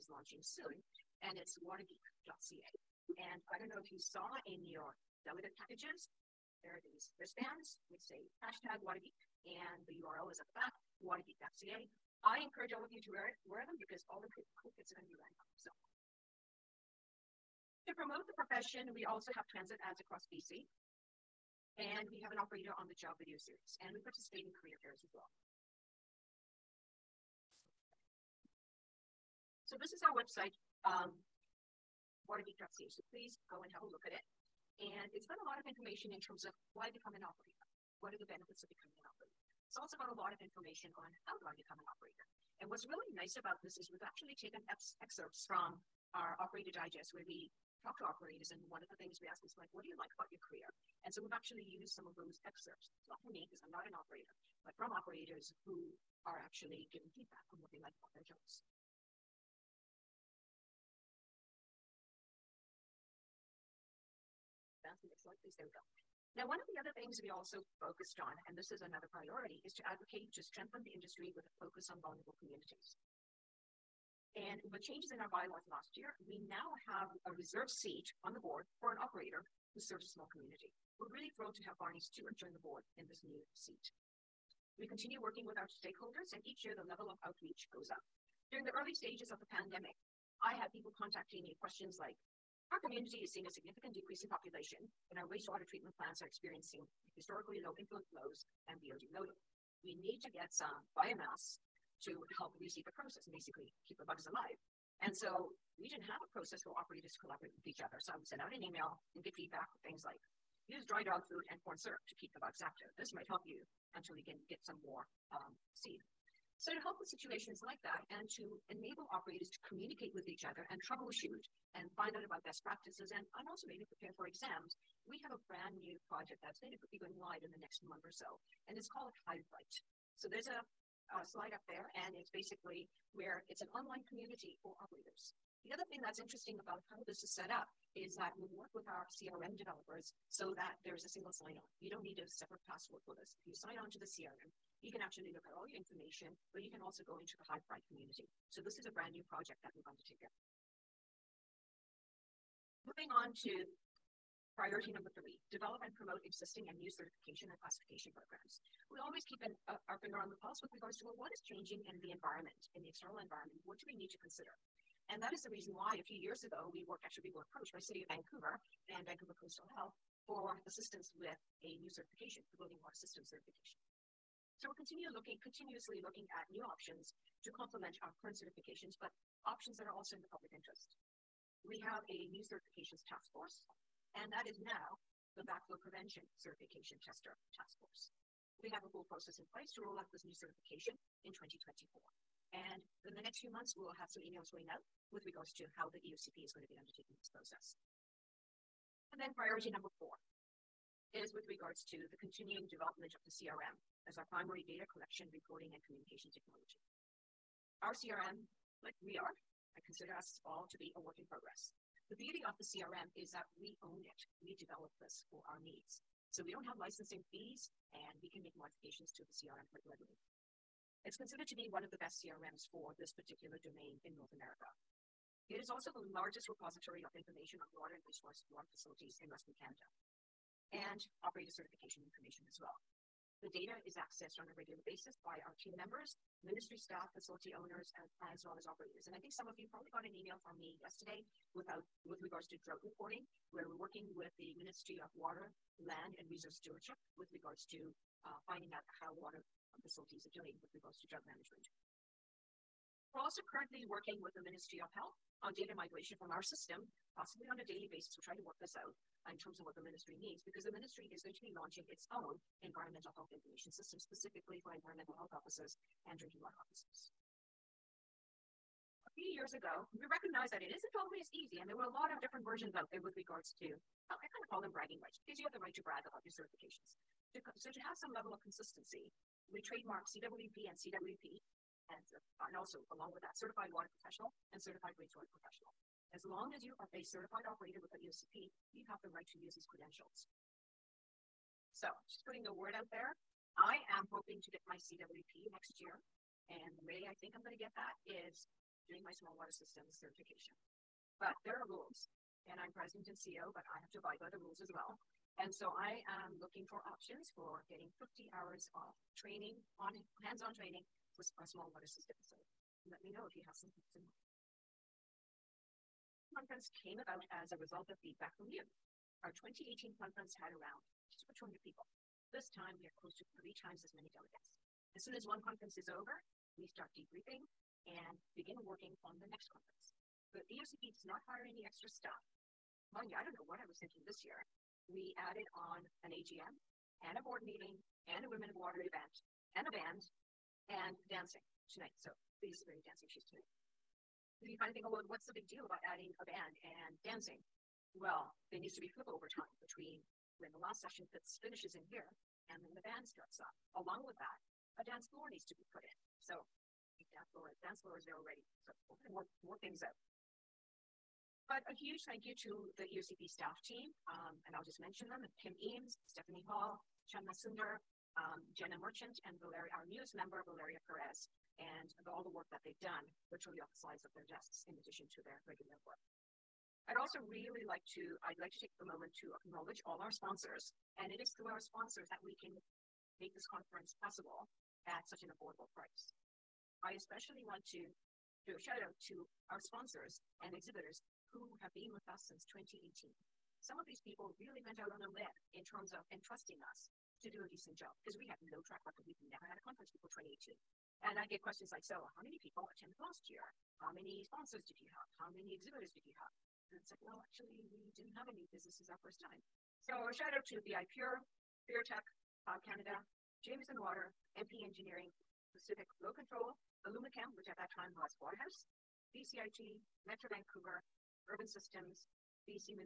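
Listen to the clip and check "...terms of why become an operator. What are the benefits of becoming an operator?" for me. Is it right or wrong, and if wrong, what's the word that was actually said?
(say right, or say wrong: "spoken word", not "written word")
right.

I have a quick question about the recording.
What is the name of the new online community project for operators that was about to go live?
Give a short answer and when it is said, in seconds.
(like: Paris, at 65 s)
Highlight, at 129 s.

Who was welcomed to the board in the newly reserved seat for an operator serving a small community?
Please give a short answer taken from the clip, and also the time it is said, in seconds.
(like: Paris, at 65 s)
Barney Stewart, at 81 s.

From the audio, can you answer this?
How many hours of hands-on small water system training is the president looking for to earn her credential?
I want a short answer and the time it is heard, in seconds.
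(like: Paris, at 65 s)
50, at 307 s.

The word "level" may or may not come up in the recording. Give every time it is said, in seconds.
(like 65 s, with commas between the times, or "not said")
86 s, 278 s.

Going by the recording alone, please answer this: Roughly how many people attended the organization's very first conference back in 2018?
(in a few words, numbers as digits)
just over 200.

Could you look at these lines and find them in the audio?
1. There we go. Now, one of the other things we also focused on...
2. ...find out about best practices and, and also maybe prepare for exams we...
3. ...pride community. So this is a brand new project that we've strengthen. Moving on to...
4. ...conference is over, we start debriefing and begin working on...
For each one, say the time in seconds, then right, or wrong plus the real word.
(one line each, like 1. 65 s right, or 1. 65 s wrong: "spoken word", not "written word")
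1. 65 s right
2. 121 s right
3. 147 s wrong: "undertaken", not "strengthen"
4. 325 s right.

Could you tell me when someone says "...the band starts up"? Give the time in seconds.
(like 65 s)
352 s.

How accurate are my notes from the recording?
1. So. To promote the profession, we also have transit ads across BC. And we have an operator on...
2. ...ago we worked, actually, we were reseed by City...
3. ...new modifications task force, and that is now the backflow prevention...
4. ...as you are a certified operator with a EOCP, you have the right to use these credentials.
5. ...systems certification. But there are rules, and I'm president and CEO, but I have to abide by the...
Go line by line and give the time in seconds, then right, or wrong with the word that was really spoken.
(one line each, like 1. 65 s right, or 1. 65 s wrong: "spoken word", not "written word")
1. 15 s right
2. 166 s wrong: "approached", not "reseed"
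3. 182 s wrong: "certifications", not "modifications"
4. 286 s right
5. 299 s right.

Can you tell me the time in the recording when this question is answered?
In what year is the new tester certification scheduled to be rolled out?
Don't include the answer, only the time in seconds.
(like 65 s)
191 s.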